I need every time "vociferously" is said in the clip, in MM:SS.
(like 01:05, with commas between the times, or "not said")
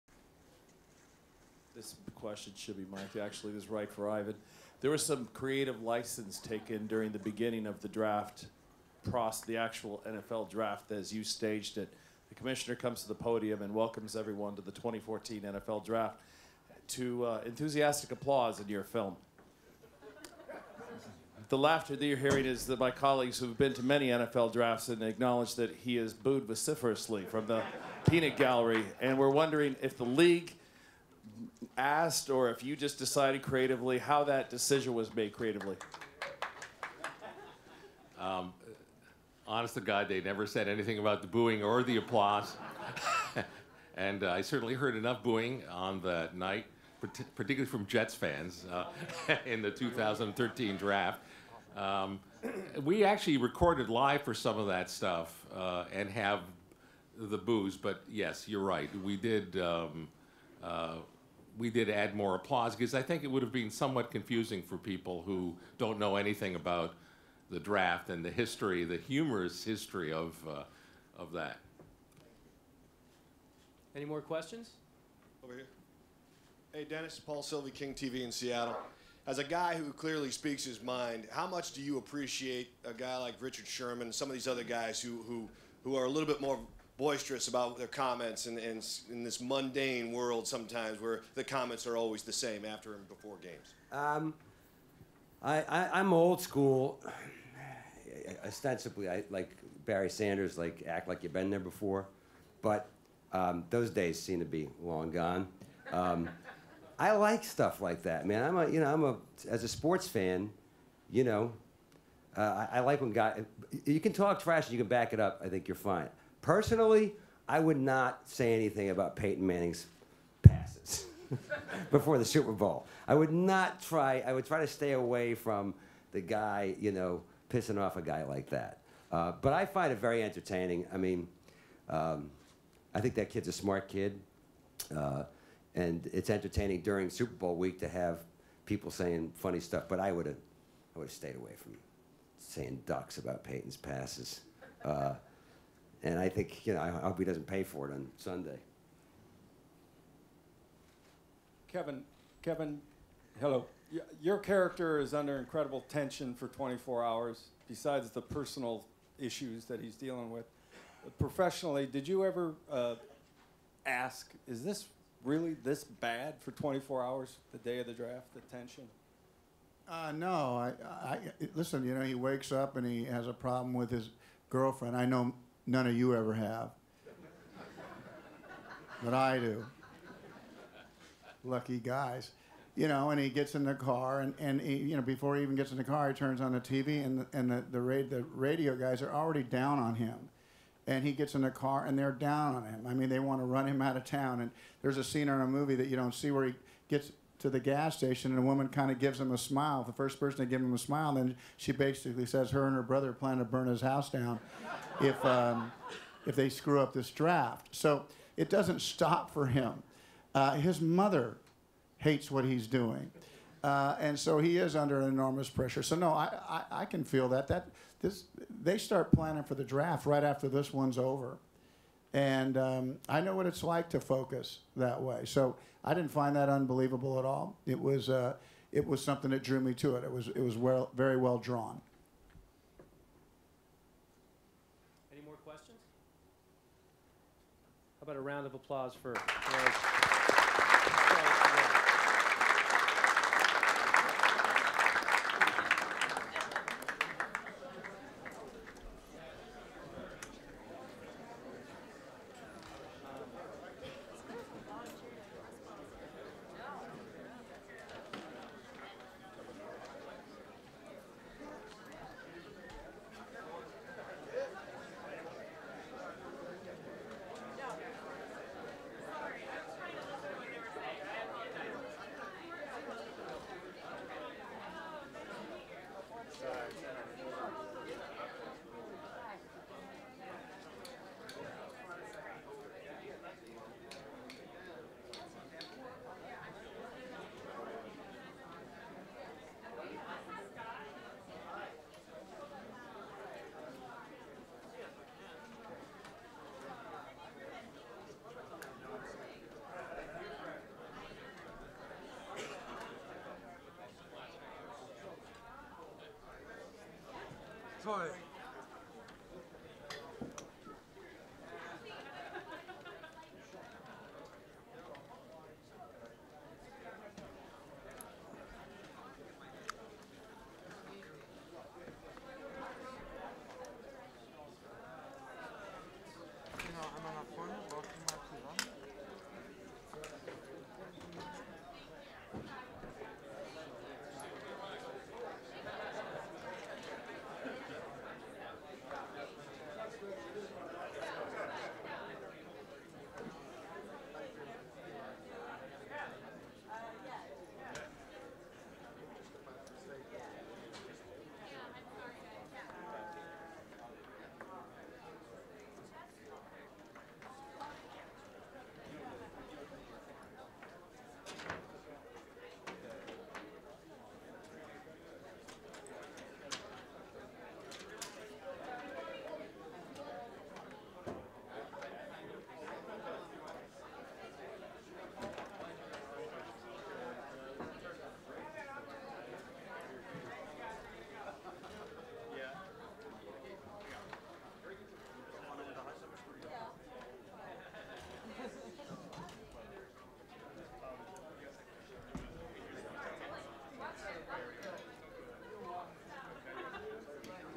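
00:26.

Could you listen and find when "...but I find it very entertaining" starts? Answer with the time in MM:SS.
02:09.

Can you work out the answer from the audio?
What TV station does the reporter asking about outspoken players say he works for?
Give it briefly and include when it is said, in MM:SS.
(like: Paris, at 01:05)
King TV, at 01:17.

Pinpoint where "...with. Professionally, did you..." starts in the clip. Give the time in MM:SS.
02:40.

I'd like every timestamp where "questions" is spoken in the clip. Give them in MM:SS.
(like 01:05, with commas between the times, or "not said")
00:02, 01:14, 03:55.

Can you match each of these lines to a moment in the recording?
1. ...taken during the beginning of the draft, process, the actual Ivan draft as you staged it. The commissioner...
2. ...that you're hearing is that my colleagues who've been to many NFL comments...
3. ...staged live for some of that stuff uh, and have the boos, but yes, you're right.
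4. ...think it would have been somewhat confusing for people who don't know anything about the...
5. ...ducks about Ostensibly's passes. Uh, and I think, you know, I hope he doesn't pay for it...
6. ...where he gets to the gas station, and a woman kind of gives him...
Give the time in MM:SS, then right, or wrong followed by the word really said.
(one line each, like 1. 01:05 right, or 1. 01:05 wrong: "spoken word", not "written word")
1. 00:06 wrong: "NFL", not "Ivan"
2. 00:21 wrong: "drafts", not "comments"
3. 00:53 wrong: "recorded", not "staged"
4. 01:03 right
5. 02:22 wrong: "Peyton", not "Ostensibly"
6. 03:16 right.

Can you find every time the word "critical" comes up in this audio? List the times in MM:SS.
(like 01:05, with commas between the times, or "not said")
not said.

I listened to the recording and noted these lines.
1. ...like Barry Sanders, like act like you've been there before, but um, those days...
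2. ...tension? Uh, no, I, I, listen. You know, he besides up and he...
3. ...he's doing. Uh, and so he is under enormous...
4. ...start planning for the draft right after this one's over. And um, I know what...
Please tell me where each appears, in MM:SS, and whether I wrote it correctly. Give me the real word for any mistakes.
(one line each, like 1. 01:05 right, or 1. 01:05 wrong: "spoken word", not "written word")
1. 01:39 right
2. 02:48 wrong: "wakes", not "besides"
3. 03:32 right
4. 03:38 right.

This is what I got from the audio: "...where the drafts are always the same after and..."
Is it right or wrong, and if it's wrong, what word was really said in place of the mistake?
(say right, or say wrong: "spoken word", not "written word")
wrong: "comments", not "drafts".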